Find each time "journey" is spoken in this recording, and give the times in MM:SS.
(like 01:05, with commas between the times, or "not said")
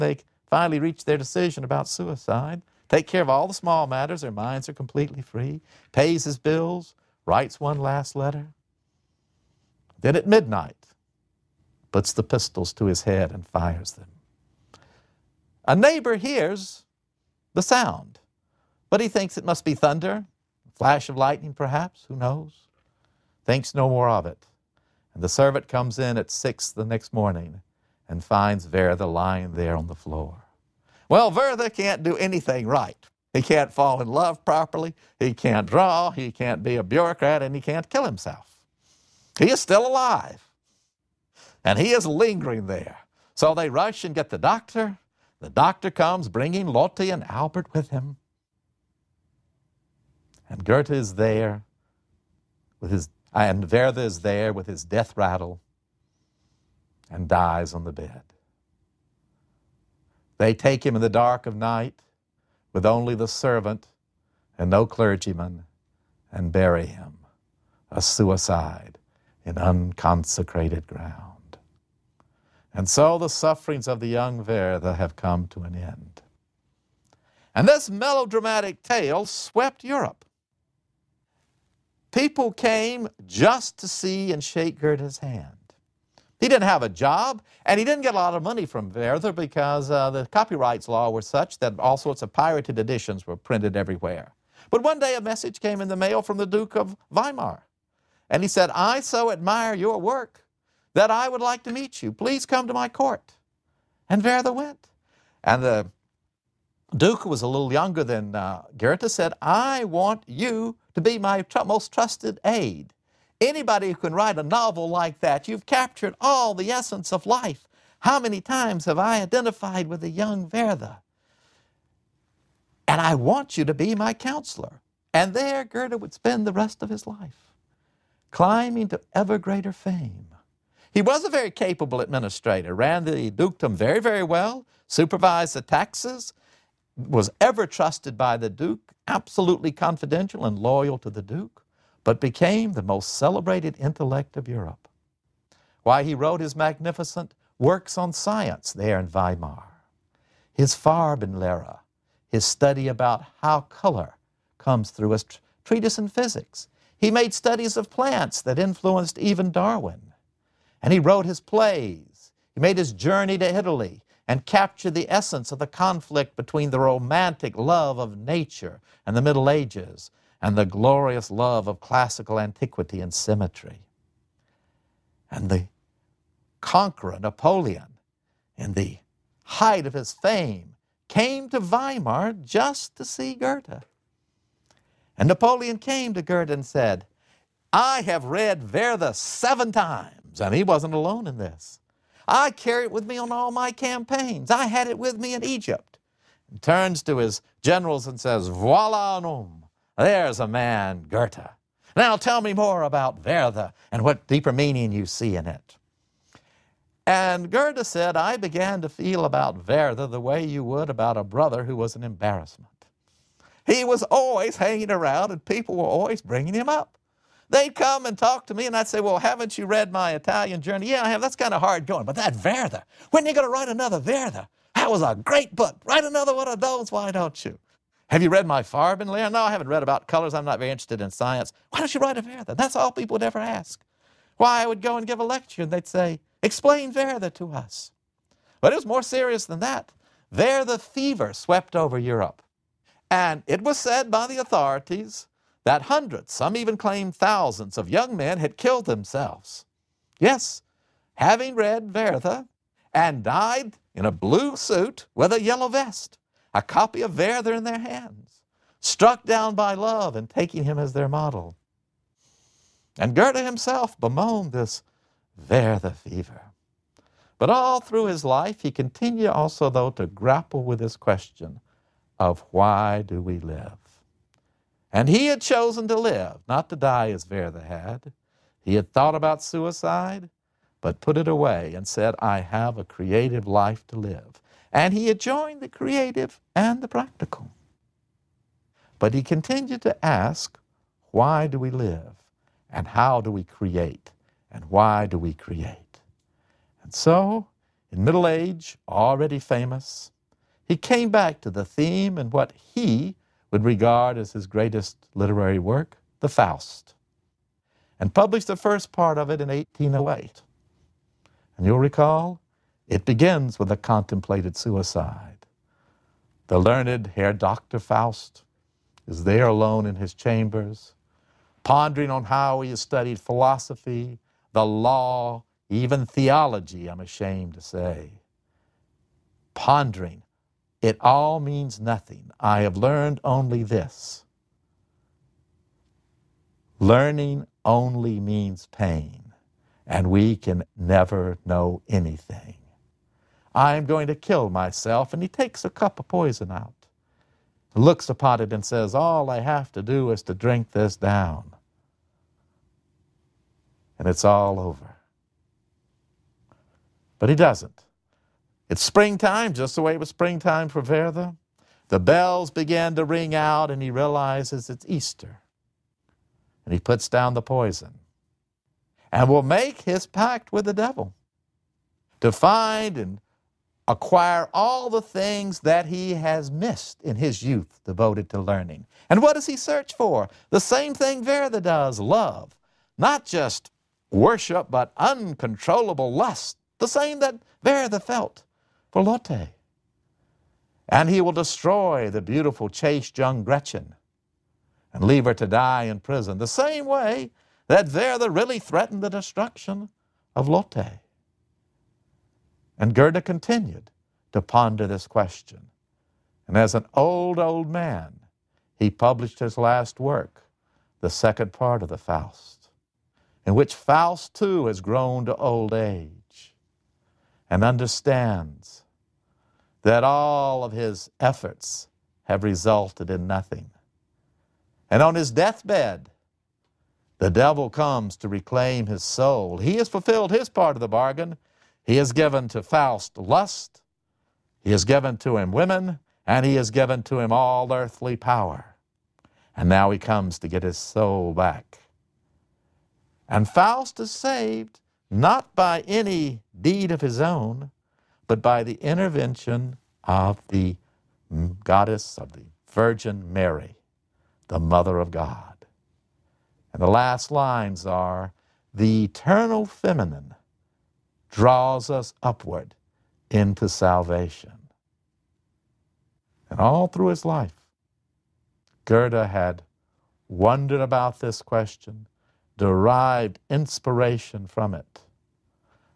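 02:42, 03:40.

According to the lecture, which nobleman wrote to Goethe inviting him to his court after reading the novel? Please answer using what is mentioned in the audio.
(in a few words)
Duke of Weimar.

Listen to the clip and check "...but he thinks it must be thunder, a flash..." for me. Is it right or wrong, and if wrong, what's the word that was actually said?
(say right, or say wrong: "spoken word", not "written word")
right.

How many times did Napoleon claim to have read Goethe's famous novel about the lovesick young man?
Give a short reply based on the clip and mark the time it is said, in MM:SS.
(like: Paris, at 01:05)
7, at 03:09.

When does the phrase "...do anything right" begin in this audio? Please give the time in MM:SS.
00:32.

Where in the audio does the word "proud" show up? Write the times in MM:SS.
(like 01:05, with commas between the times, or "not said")
not said.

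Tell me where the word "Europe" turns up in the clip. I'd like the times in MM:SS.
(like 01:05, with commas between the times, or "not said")
01:19, 02:24, 04:01.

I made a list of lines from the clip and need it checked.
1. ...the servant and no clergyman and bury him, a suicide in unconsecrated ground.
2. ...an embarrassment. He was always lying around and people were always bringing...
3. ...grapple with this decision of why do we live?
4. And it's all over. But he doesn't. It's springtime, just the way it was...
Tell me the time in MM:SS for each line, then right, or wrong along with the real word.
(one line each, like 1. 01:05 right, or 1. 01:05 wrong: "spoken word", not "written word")
1. 01:03 right
2. 03:31 wrong: "hanging", not "lying"
3. 04:30 wrong: "question", not "decision"
4. 05:53 right.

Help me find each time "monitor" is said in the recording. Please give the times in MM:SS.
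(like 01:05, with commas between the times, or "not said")
not said.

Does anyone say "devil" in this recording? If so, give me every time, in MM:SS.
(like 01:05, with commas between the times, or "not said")
06:10, 07:07.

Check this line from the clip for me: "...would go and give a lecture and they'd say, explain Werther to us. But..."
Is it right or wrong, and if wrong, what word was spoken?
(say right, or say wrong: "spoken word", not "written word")
right.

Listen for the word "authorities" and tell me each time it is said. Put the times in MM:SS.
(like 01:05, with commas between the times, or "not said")
04:04.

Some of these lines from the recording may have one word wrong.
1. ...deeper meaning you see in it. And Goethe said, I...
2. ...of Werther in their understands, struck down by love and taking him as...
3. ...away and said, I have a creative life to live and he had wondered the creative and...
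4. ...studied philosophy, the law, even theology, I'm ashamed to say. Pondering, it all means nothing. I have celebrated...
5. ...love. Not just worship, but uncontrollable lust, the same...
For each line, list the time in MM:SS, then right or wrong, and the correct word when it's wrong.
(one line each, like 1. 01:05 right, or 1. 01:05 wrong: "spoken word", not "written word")
1. 03:24 right
2. 04:17 wrong: "hands", not "understands"
3. 04:41 wrong: "joined", not "wondered"
4. 05:22 wrong: "learned", not "celebrated"
5. 06:21 right.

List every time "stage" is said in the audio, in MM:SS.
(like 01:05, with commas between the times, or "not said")
not said.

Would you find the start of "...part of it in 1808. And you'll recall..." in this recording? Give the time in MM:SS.
05:08.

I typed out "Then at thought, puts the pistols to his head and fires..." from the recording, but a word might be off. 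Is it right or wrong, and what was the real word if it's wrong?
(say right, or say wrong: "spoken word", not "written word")
wrong: "midnight", not "thought".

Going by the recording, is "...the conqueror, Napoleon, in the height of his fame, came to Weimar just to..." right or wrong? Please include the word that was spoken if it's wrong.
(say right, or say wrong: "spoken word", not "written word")
right.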